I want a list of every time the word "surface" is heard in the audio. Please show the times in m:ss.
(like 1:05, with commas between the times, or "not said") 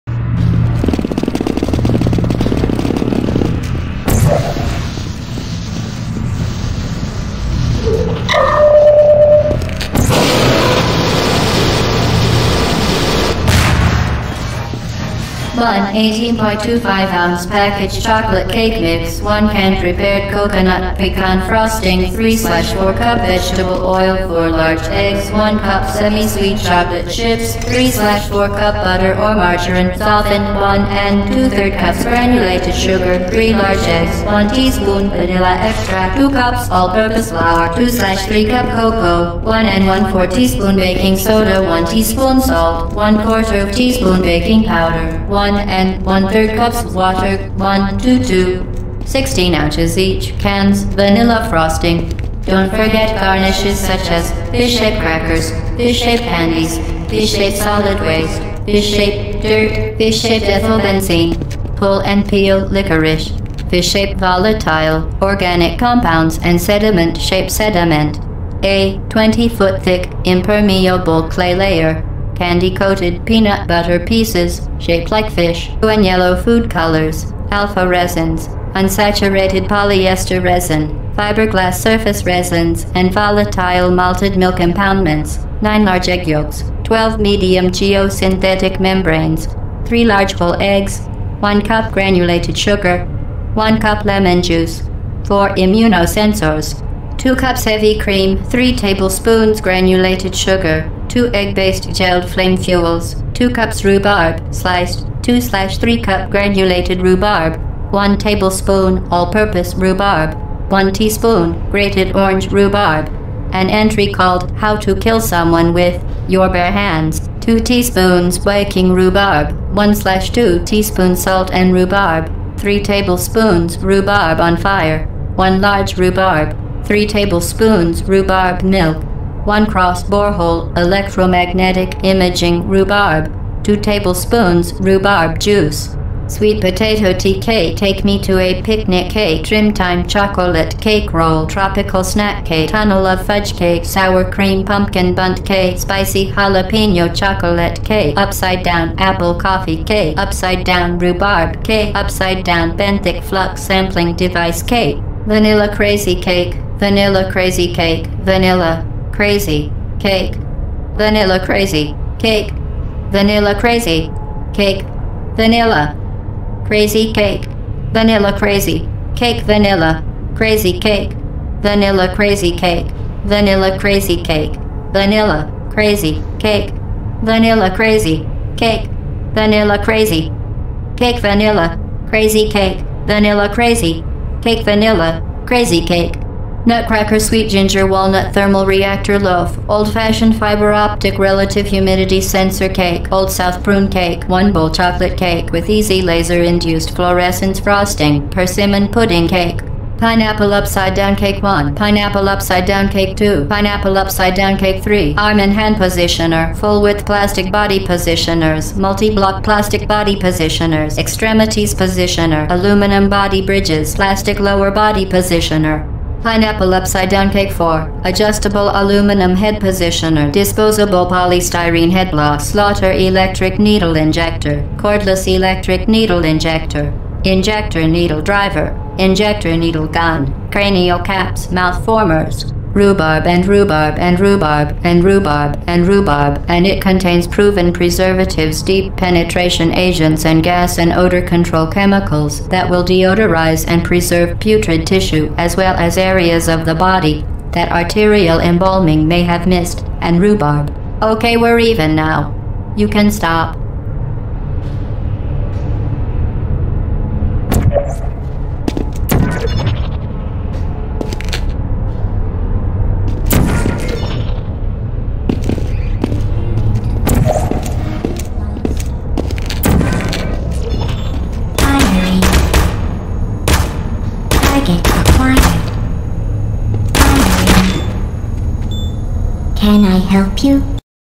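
1:21.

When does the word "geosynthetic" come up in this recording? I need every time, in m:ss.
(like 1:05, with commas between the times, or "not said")
1:27.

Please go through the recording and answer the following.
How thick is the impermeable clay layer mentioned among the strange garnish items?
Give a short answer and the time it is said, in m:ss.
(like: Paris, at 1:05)
20 feet, at 1:09.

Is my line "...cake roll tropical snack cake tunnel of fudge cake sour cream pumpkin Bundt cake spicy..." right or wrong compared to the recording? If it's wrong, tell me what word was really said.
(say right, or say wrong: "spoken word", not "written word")
right.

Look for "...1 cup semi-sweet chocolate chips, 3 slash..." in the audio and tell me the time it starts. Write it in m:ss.
0:25.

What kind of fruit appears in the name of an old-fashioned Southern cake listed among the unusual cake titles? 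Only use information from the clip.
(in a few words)
Prune.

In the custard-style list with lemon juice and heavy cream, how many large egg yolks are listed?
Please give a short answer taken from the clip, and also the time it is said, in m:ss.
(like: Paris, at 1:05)
9, at 1:25.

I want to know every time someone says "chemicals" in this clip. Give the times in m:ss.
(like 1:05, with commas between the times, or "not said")
4:01.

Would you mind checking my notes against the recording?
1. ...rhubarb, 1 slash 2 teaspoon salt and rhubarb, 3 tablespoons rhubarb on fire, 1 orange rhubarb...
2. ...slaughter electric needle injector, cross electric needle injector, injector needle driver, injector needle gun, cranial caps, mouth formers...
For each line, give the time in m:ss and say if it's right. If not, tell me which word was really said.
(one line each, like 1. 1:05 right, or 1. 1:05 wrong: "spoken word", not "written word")
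1. 1:58 wrong: "large", not "orange"
2. 3:42 wrong: "cordless", not "cross".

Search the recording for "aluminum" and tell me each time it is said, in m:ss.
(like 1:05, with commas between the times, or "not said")
3:32, 3:38.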